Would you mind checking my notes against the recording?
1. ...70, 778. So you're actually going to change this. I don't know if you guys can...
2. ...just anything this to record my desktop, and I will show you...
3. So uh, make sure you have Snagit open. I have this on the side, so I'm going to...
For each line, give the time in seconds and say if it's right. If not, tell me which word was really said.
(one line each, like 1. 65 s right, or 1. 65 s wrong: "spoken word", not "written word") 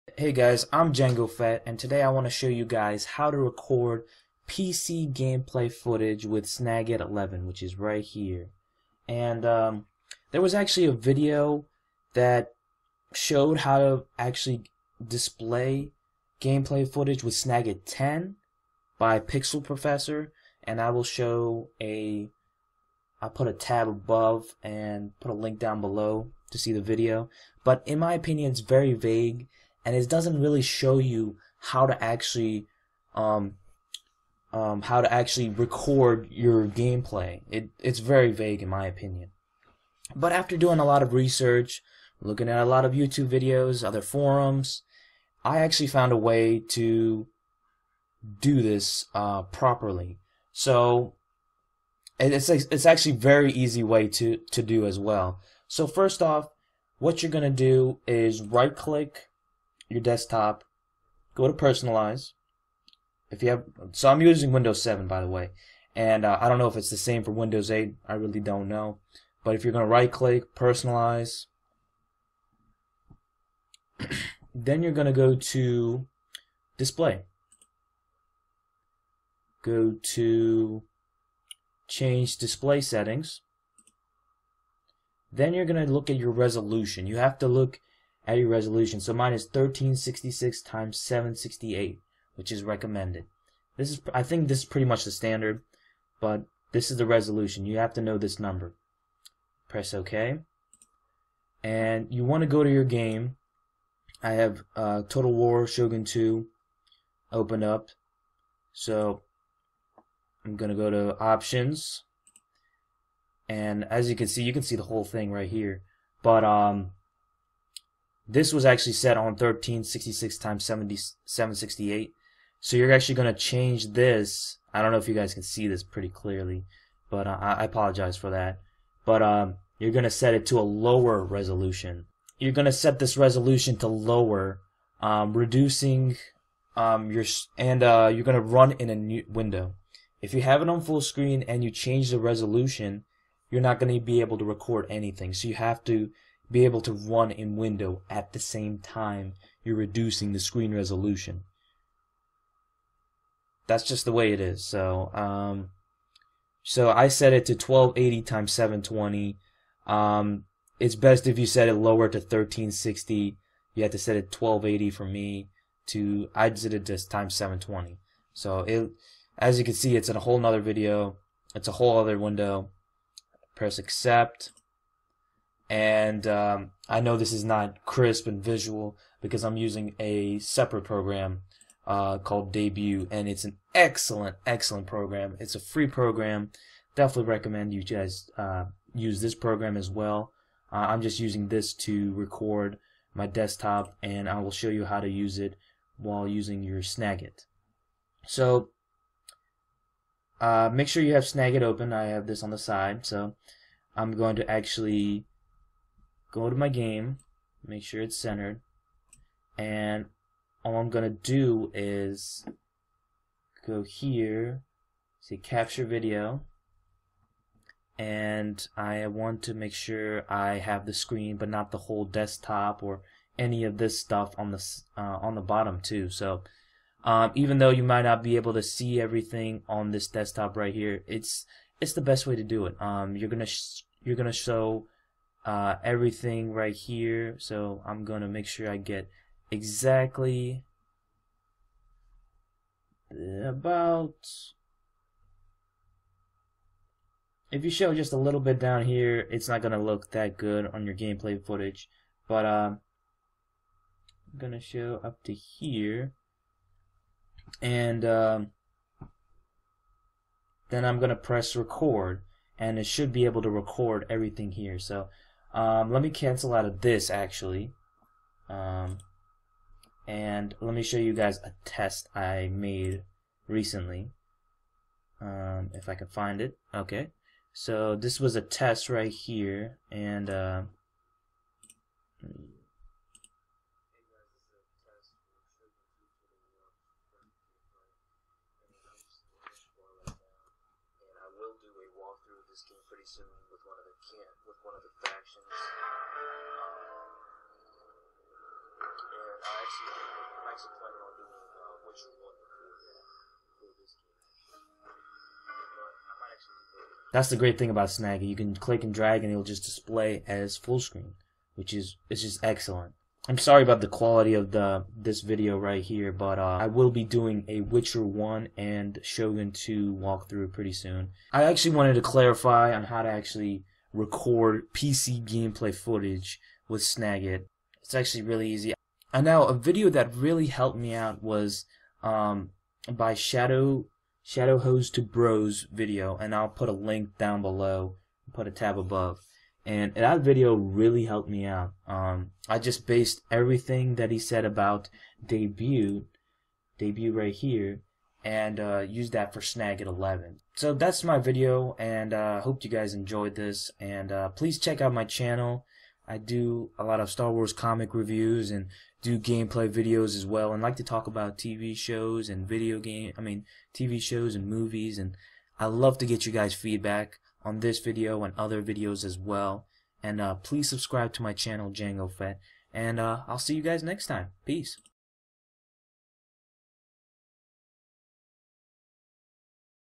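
1. 120 s wrong: "768", not "778"
2. 191 s wrong: "using", not "anything"
3. 198 s right.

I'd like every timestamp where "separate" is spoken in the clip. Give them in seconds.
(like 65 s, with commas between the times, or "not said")
180 s.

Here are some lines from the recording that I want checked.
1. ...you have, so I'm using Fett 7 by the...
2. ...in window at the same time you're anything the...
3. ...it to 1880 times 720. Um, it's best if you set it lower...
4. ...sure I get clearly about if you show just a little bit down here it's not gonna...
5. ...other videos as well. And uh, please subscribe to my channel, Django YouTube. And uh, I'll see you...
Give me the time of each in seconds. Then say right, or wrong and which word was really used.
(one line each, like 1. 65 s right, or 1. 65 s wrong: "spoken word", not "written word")
1. 63 s wrong: "Windows", not "Fett"
2. 147 s wrong: "reducing", not "anything"
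3. 157 s wrong: "1280", not "1880"
4. 238 s wrong: "exactly", not "clearly"
5. 368 s wrong: "Fett", not "YouTube".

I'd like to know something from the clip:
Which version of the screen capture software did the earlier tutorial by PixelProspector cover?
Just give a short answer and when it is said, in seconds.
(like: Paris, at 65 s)
Snagit 10, at 17 s.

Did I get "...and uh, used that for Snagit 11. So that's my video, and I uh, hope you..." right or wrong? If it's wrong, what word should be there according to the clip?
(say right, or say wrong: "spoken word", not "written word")
right.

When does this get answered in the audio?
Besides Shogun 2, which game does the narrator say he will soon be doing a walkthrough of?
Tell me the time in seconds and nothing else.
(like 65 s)
317 s.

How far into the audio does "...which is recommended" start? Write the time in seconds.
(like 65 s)
92 s.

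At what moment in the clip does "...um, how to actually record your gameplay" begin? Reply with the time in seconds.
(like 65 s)
34 s.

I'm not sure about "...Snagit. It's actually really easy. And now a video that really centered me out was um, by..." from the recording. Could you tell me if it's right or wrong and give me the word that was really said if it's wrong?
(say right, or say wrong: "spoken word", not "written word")
wrong: "helped", not "centered".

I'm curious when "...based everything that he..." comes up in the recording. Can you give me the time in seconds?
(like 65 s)
342 s.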